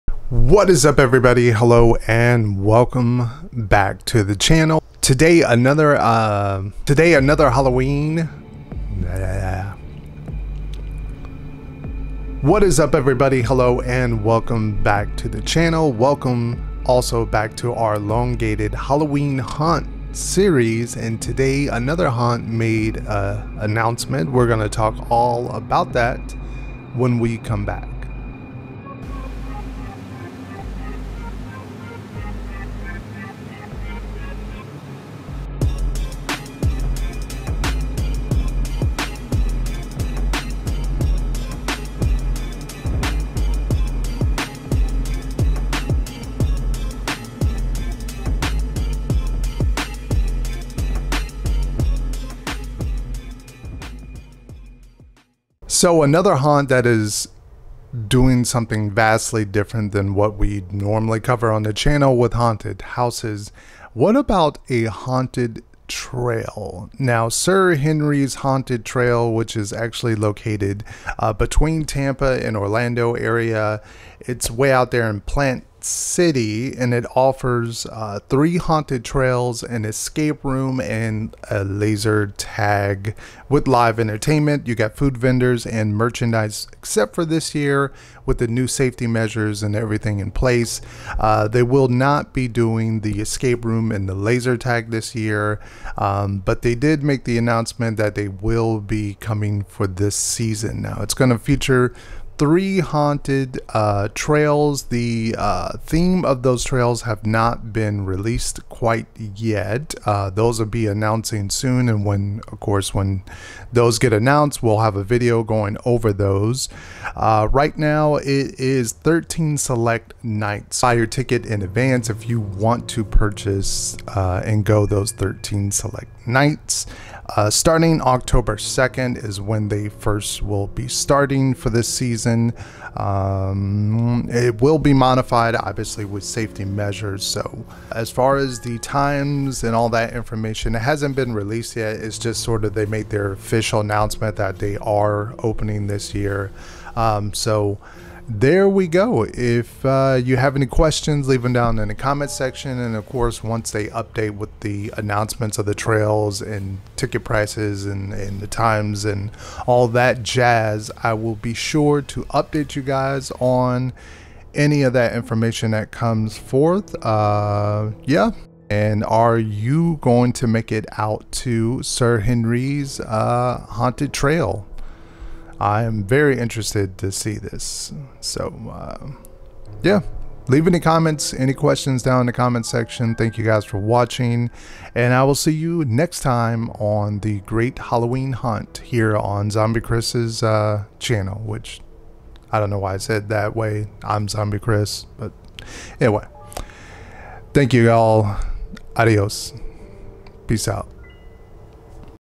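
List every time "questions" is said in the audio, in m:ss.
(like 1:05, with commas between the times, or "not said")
2:30, 3:01.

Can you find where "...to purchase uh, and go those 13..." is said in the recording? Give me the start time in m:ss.
2:02.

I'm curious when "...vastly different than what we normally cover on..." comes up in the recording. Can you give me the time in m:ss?
0:58.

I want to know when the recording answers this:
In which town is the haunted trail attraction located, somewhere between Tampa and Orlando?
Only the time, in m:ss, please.
1:15.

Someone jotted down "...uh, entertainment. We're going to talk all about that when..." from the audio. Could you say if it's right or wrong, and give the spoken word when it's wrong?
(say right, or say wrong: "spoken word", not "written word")
wrong: "announcement", not "entertainment".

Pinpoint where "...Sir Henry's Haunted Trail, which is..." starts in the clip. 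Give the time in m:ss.
1:07.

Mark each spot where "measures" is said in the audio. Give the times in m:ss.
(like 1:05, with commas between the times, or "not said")
1:29, 2:16.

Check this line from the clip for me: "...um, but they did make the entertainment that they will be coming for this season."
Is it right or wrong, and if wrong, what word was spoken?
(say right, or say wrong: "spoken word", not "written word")
wrong: "announcement", not "entertainment".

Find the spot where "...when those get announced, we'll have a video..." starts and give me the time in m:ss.
1:52.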